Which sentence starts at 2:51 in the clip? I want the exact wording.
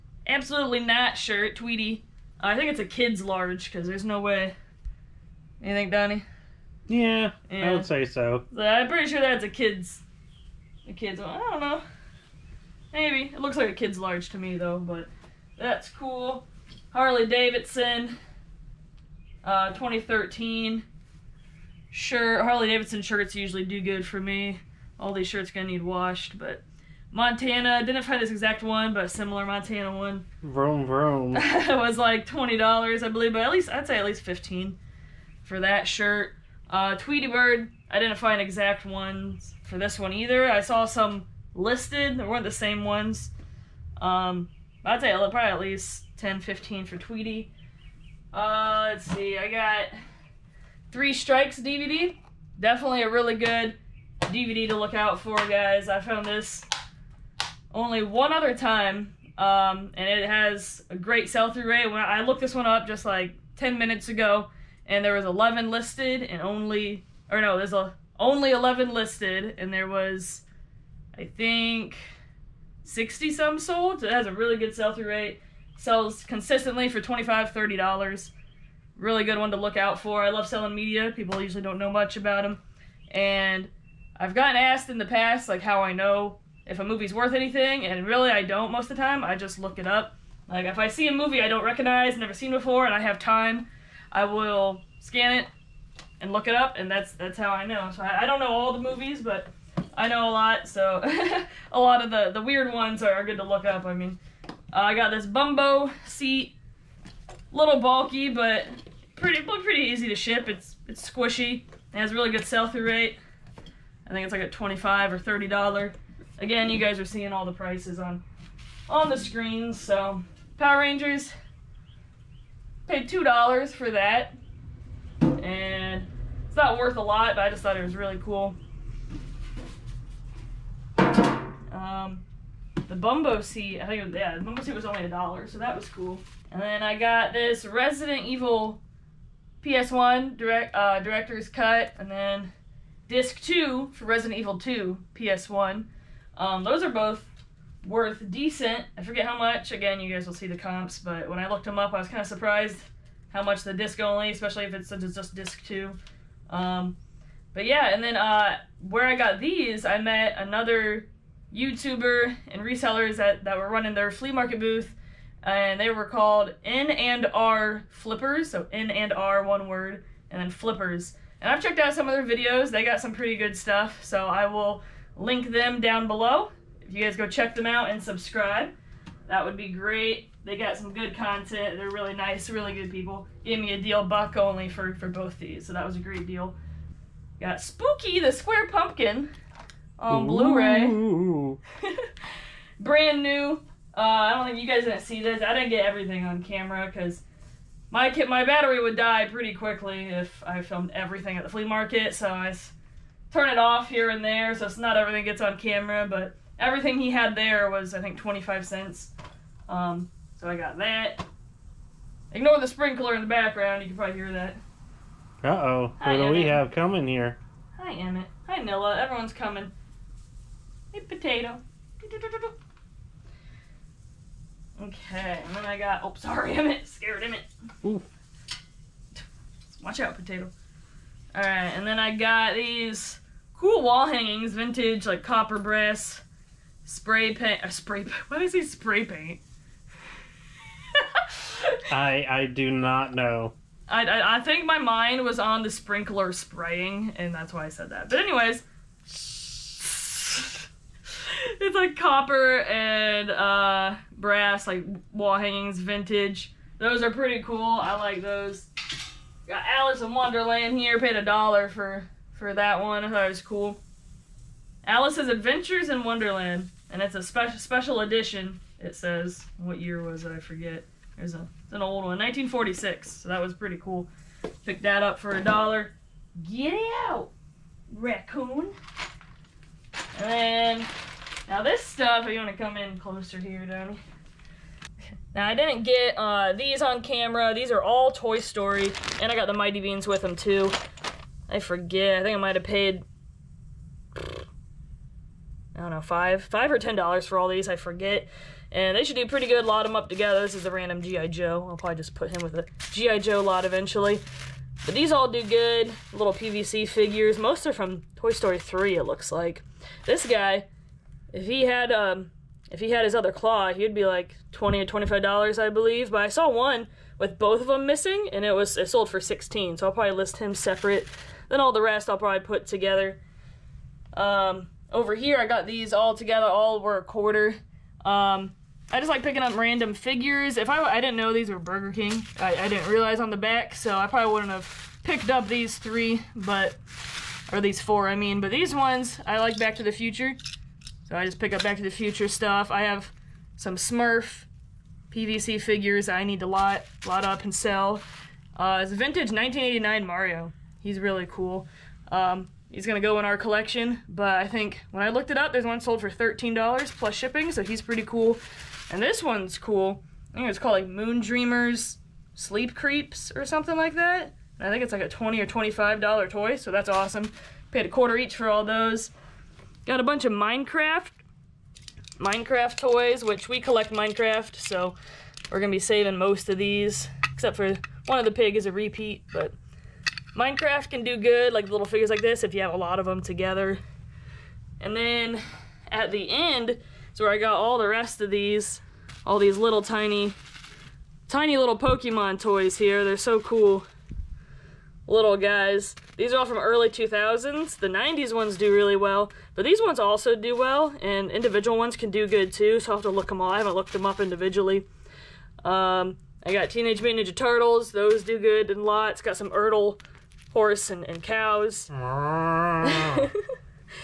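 And I've checked out some of their videos.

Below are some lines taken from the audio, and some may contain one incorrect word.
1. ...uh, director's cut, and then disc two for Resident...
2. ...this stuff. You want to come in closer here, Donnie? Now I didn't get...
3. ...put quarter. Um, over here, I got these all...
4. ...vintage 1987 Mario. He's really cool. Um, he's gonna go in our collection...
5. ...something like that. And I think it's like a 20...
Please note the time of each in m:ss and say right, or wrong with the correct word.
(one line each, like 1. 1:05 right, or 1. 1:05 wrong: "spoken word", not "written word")
1. 2:20 right
2. 4:41 right
3. 5:22 wrong: "together", not "quarter"
4. 5:48 wrong: "1989", not "1987"
5. 6:03 right.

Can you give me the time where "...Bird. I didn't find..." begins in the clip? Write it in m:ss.
0:37.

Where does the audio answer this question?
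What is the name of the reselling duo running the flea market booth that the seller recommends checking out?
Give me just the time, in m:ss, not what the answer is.
2:46.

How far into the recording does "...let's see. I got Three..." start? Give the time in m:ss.
0:48.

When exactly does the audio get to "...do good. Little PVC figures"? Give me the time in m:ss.
5:05.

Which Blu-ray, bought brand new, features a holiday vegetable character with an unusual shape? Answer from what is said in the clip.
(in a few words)
Spooky the Square Pumpkin.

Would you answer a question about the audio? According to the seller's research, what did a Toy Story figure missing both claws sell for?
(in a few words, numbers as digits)
$16.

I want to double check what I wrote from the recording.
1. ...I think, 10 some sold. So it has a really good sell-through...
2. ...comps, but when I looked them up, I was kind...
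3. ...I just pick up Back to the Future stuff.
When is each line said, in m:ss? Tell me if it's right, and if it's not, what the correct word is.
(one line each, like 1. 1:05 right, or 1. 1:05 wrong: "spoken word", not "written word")
1. 1:11 wrong: "60", not "10"
2. 2:30 right
3. 5:41 right.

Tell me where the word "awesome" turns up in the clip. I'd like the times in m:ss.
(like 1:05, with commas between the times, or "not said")
6:06.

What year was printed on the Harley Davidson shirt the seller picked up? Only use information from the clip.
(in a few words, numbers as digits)
2013.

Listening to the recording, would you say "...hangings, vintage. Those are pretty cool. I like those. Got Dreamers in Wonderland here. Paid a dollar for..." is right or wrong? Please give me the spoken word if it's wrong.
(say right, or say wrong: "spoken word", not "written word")
wrong: "Alice", not "Dreamers".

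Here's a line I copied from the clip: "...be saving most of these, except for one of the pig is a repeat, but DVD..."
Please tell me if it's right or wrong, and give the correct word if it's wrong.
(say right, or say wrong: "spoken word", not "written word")
wrong: "Minecraft", not "DVD".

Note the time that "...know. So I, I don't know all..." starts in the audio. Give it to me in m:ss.
1:37.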